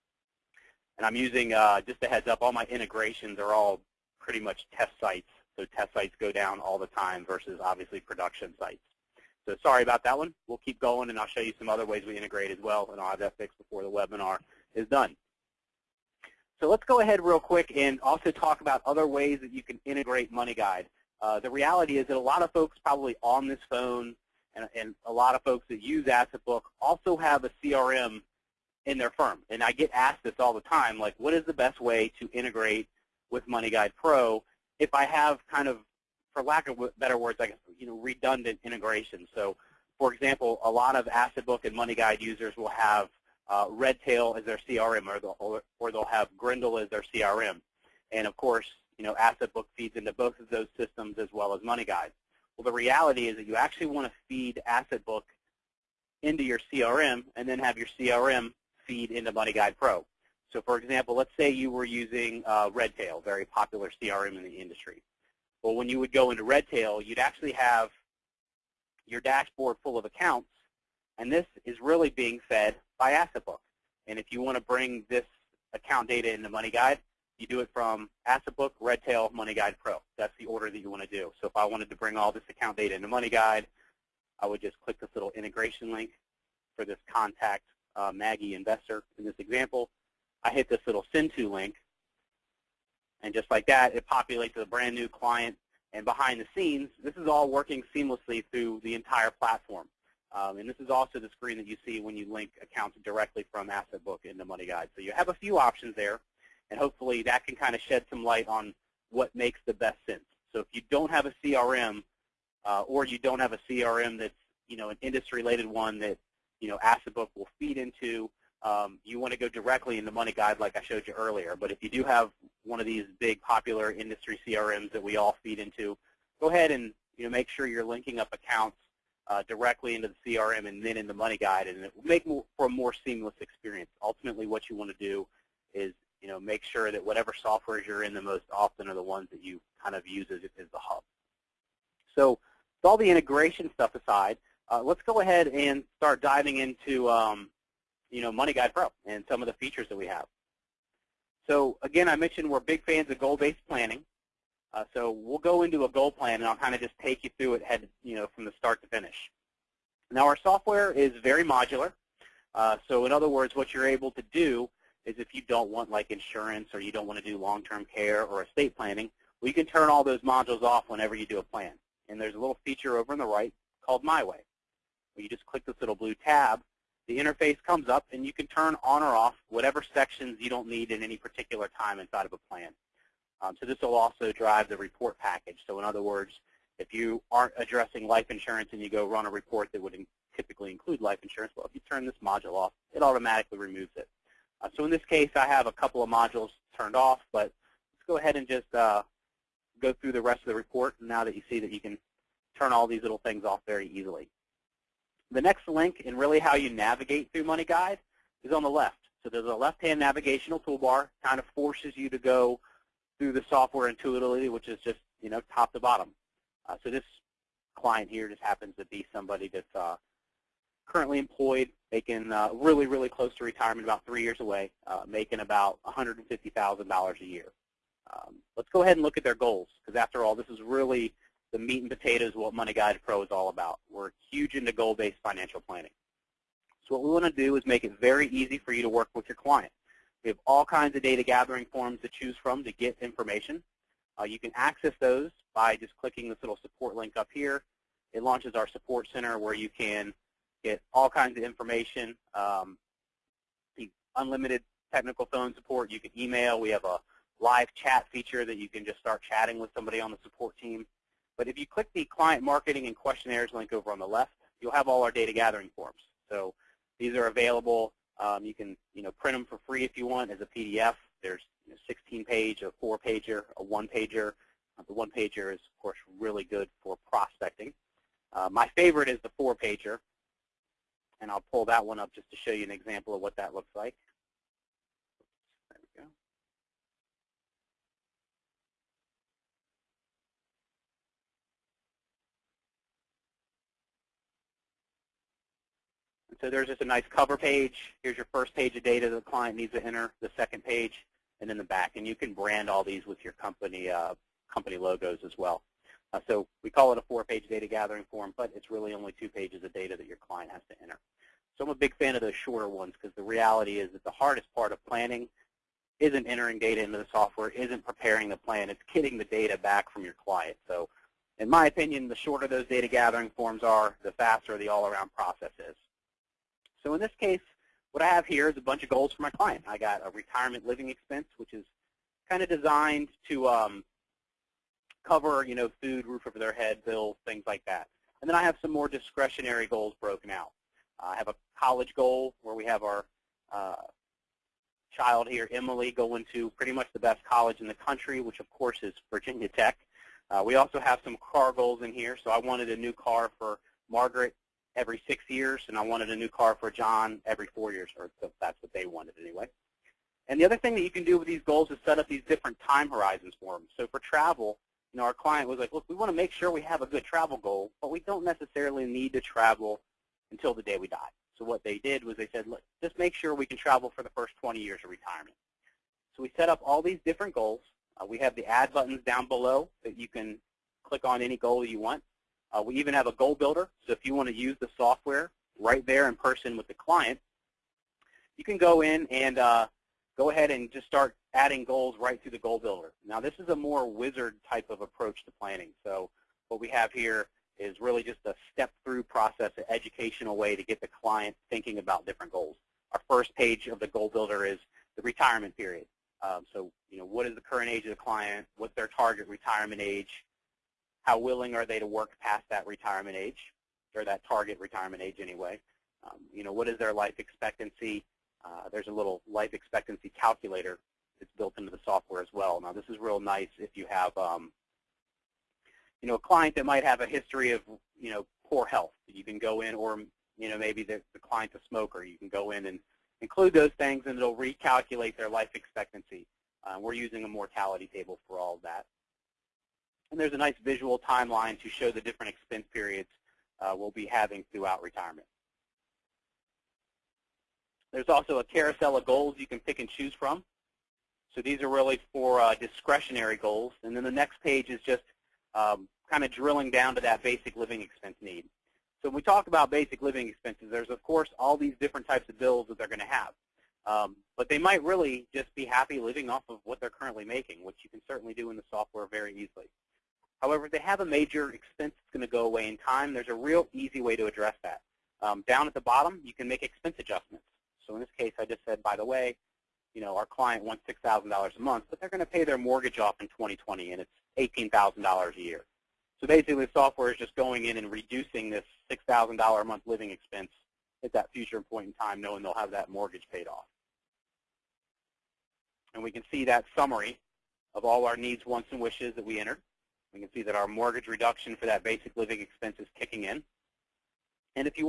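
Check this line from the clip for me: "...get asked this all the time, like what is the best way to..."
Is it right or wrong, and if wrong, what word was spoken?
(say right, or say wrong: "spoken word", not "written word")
right.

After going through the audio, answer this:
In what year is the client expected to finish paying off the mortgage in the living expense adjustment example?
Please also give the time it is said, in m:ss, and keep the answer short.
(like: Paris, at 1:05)
2020, at 8:03.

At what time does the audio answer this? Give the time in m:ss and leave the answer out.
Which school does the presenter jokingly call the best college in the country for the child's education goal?
5:49.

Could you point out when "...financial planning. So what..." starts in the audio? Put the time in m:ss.
3:55.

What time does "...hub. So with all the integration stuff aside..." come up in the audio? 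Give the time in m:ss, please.
2:20.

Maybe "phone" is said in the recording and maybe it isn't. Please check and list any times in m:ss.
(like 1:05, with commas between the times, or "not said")
0:23, 4:15.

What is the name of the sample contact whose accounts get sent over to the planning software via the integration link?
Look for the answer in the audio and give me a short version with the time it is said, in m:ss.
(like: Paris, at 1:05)
Maggie investor, at 1:28.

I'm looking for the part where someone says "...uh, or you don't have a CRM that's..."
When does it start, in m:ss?
1:52.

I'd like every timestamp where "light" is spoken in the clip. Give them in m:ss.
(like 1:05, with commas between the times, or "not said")
1:48.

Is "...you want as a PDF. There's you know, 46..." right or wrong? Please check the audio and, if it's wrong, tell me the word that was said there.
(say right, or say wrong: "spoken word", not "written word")
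wrong: "16", not "46".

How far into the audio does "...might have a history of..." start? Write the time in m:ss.
7:06.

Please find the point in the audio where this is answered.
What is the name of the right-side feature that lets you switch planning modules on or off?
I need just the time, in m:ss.
2:54.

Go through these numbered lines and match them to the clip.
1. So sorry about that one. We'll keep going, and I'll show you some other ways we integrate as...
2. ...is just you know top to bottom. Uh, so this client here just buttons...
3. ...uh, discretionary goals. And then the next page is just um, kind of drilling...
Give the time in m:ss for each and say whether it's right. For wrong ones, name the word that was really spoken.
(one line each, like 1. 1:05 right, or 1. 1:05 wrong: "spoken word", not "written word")
1. 0:09 right
2. 3:34 wrong: "happens", not "buttons"
3. 7:32 right.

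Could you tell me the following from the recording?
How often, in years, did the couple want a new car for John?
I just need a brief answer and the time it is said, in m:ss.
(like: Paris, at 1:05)
4, at 5:57.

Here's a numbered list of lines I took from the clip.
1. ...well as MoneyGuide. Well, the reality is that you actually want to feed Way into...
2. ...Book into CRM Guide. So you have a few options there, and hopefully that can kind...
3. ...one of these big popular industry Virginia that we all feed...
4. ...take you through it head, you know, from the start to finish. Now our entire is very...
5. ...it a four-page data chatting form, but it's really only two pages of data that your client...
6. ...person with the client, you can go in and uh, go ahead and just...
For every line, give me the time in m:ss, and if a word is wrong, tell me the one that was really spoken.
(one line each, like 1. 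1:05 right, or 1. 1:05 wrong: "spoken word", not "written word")
1. 0:51 wrong: "AssetBook", not "Way"
2. 1:44 wrong: "Money", not "CRM"
3. 2:02 wrong: "CRMs", not "Virginia"
4. 2:36 wrong: "software", not "entire"
5. 5:06 wrong: "gathering", not "chatting"
6. 6:26 right.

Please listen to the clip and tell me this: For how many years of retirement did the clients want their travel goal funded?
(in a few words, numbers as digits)
20.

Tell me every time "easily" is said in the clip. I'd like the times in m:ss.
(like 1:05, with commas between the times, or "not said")
3:23, 7:49.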